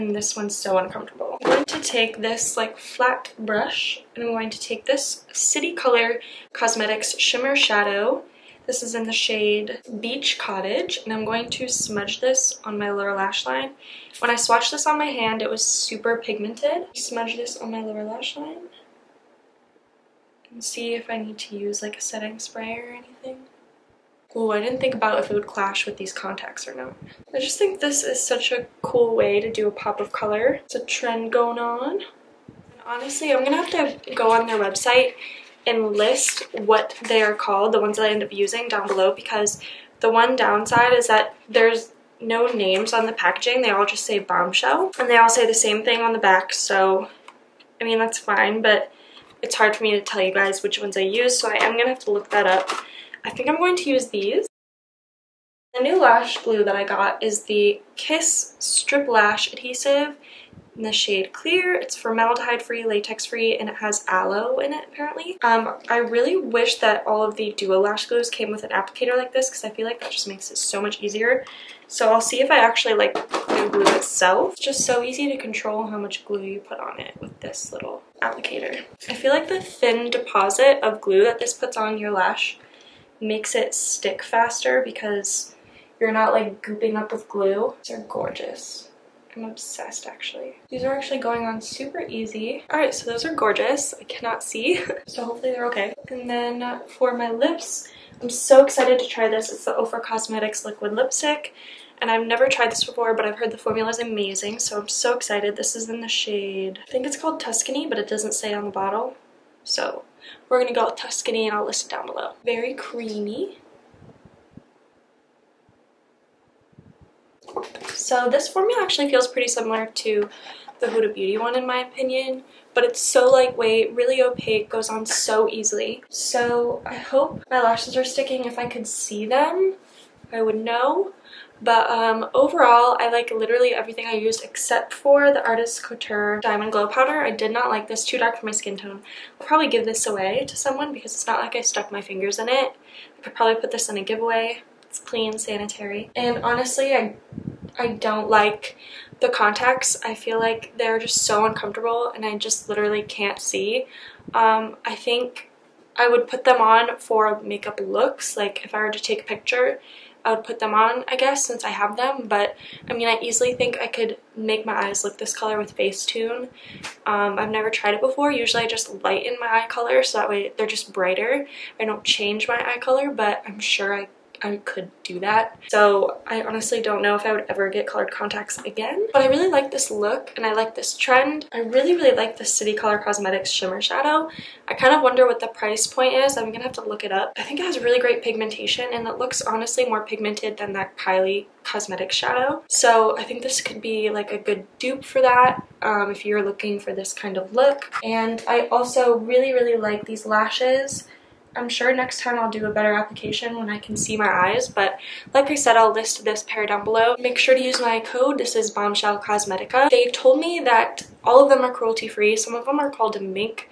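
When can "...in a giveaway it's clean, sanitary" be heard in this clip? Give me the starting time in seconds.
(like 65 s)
143 s.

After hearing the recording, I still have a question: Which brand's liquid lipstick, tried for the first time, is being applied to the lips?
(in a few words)
Ofra Cosmetics.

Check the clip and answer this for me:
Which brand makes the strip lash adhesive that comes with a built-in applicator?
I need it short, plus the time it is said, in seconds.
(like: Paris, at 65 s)
Kiss, at 57 s.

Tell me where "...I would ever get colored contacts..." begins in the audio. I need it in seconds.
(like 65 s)
177 s.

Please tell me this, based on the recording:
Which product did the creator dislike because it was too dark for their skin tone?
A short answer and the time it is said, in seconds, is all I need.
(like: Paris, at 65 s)
Artist Couture Diamond Glow Powder, at 135 s.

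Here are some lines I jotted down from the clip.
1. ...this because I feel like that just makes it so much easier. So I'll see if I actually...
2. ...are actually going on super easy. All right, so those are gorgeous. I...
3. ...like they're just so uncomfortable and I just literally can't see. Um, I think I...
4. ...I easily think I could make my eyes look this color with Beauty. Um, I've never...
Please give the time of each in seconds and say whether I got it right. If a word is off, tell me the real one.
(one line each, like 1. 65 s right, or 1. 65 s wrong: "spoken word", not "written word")
1. 69 s right
2. 90 s right
3. 150 s right
4. 163 s wrong: "Facetune", not "Beauty".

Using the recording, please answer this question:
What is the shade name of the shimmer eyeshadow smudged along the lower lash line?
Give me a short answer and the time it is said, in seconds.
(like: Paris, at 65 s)
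Beach Cottage, at 10 s.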